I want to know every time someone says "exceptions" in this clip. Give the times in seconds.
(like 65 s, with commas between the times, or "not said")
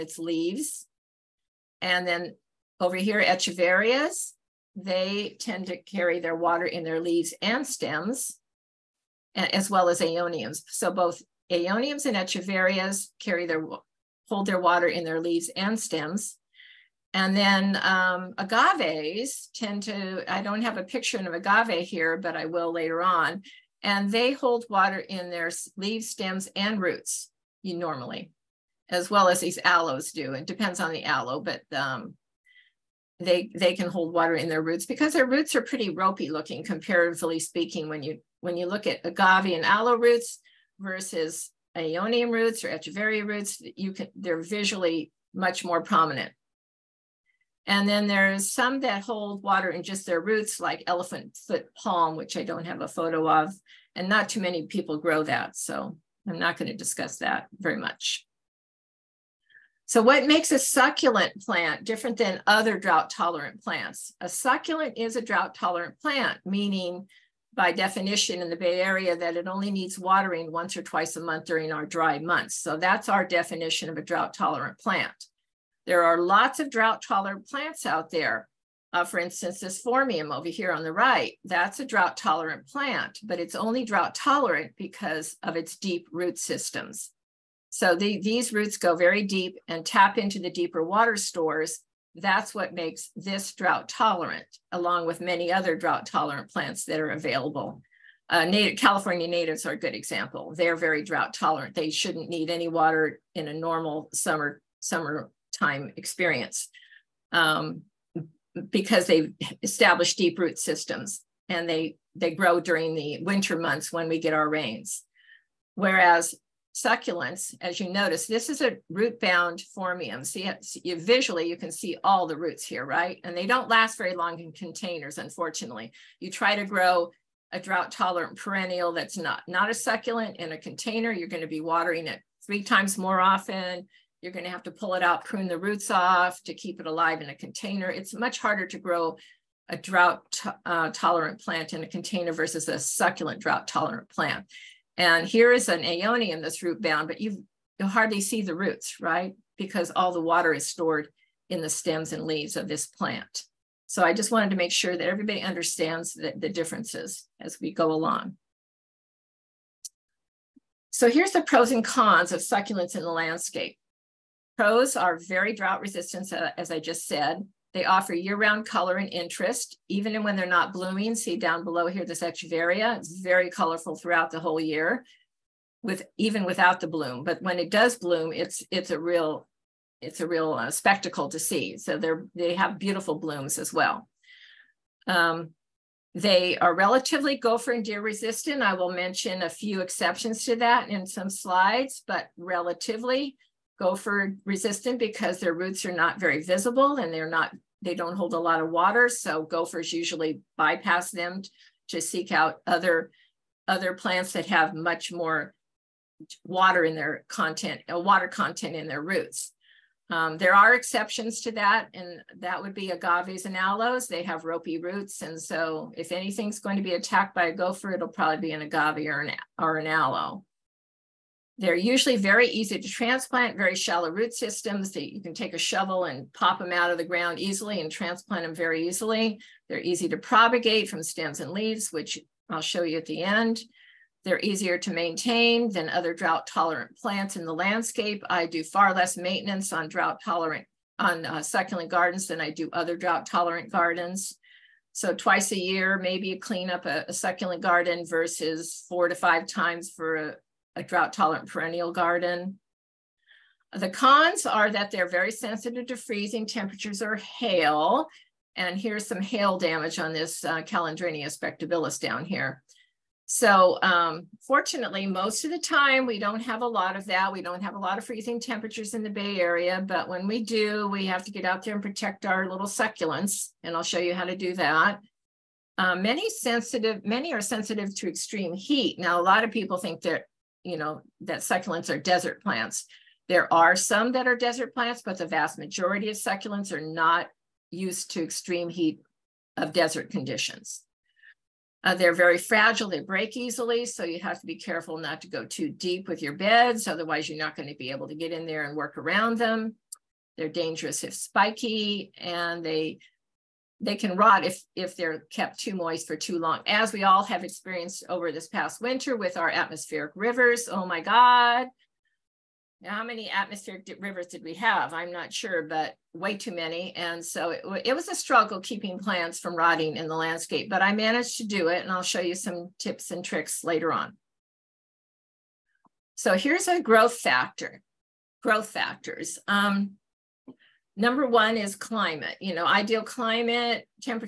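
189 s, 210 s.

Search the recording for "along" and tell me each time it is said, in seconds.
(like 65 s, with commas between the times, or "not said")
94 s, 157 s.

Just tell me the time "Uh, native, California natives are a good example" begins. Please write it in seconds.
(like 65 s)
98 s.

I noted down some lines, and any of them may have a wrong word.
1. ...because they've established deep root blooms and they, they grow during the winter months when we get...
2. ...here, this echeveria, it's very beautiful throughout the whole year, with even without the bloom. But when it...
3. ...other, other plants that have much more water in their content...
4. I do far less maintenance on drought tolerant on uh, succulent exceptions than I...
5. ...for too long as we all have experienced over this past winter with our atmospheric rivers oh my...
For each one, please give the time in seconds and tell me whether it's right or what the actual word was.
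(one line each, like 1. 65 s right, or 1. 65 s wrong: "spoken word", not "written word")
1. 108 s wrong: "systems", not "blooms"
2. 171 s wrong: "colorful", not "beautiful"
3. 202 s right
4. 238 s wrong: "gardens", not "exceptions"
5. 306 s right.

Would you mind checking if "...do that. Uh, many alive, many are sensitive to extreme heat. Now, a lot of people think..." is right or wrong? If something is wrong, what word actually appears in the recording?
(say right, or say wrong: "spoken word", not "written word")
wrong: "sensitive", not "alive".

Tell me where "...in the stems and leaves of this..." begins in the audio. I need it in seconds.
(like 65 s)
151 s.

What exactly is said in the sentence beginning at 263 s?
So um, fortunately, most of the time we don't have a lot of that.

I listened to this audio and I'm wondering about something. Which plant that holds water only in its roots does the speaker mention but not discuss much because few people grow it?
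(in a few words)
Elephant foot palm.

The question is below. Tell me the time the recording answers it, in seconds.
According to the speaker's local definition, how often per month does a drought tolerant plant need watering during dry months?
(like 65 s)
70 s.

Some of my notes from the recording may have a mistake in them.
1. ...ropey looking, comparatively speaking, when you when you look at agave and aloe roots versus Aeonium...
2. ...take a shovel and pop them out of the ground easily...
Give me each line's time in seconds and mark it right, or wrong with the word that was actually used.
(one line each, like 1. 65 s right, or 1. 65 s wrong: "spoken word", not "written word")
1. 35 s right
2. 225 s right.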